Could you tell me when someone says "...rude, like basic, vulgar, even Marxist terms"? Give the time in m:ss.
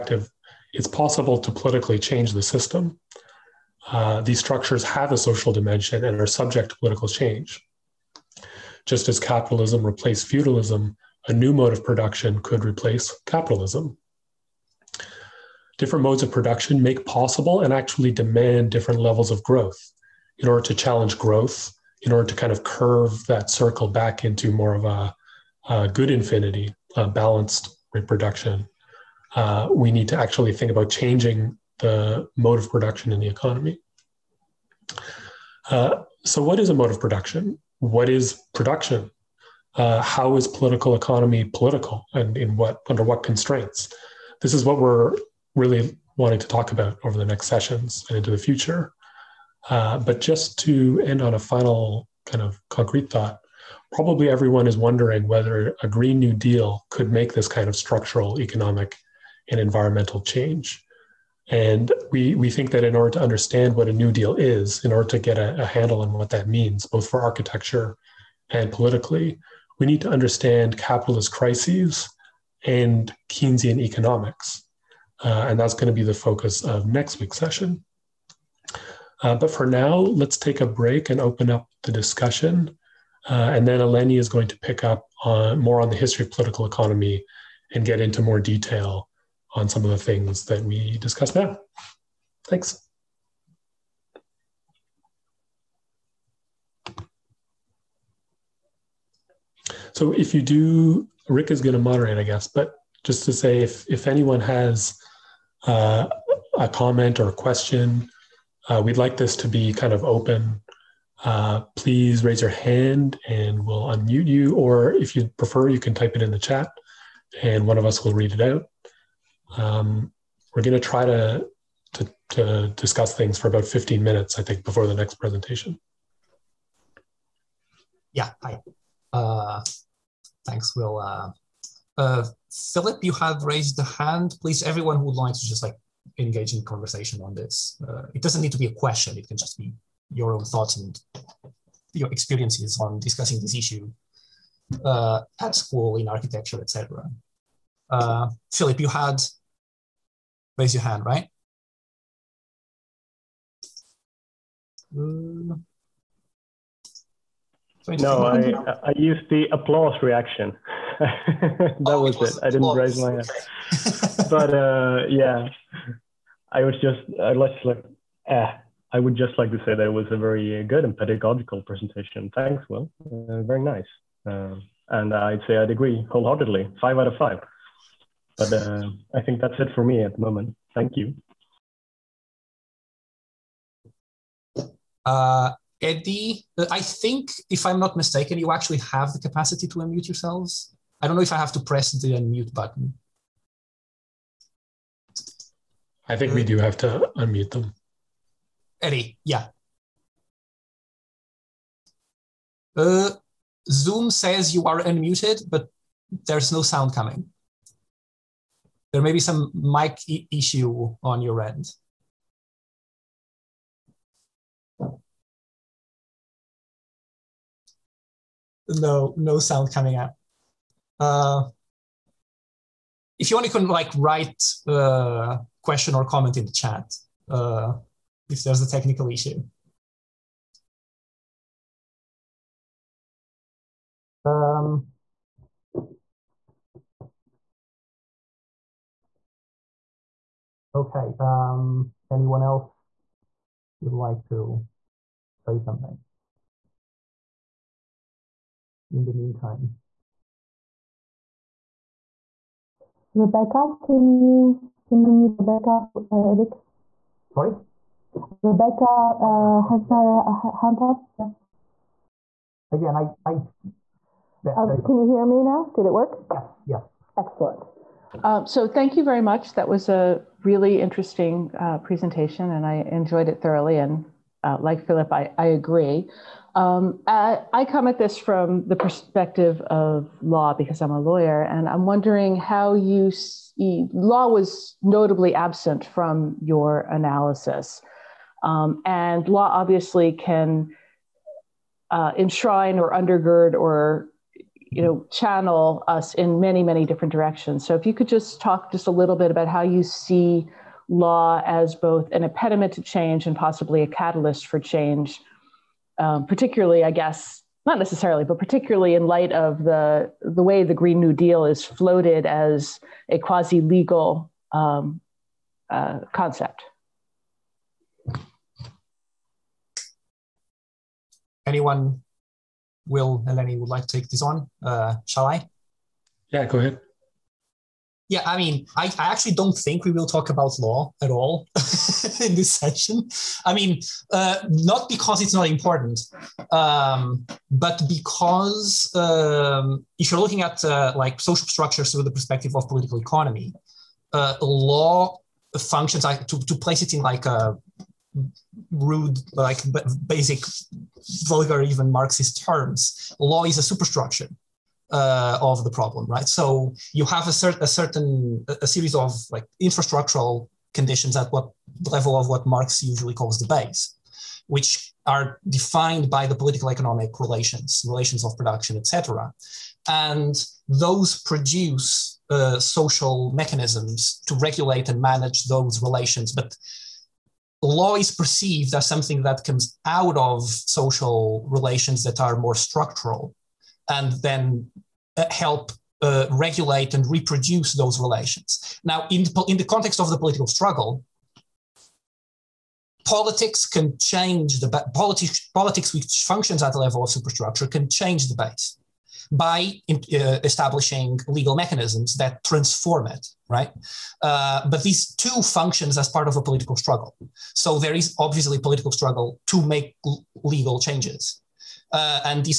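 5:48.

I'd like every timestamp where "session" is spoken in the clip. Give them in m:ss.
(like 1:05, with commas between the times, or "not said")
0:47, 1:17, 5:32.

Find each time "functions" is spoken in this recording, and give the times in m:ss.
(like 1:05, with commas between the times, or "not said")
5:45, 6:36, 6:45.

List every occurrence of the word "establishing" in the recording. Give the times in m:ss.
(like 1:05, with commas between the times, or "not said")
6:40.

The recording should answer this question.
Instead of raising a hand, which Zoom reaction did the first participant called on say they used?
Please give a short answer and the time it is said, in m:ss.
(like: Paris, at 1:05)
Applause, at 2:39.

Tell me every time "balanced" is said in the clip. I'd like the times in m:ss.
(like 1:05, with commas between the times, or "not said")
0:27.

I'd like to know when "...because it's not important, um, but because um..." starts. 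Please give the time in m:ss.
5:34.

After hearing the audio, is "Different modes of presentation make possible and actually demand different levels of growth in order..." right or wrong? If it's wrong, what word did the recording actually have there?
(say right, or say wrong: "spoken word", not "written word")
wrong: "production", not "presentation".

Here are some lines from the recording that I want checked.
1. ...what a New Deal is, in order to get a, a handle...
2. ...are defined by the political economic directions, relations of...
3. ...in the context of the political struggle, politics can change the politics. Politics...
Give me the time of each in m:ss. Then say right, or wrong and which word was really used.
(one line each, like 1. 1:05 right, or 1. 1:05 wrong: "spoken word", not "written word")
1. 1:03 right
2. 6:05 wrong: "relations", not "directions"
3. 6:29 right.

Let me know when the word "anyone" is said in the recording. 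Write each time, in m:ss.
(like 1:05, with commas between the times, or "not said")
1:44, 4:02, 5:21.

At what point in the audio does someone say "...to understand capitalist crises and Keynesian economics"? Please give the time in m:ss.
1:10.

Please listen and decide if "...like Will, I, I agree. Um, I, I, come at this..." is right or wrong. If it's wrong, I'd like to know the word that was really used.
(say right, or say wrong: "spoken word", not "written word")
wrong: "Philip", not "Will".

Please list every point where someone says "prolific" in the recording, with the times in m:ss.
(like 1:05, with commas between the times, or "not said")
not said.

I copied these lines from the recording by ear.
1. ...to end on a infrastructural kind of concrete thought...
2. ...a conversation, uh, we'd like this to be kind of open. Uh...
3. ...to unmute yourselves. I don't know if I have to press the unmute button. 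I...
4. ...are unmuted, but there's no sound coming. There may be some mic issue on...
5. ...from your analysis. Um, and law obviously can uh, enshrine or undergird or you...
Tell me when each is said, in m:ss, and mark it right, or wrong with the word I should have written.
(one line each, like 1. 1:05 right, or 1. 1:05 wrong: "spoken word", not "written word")
1. 0:50 wrong: "final", not "infrastructural"
2. 1:47 wrong: "question", not "conversation"
3. 3:09 right
4. 3:24 right
5. 4:45 right.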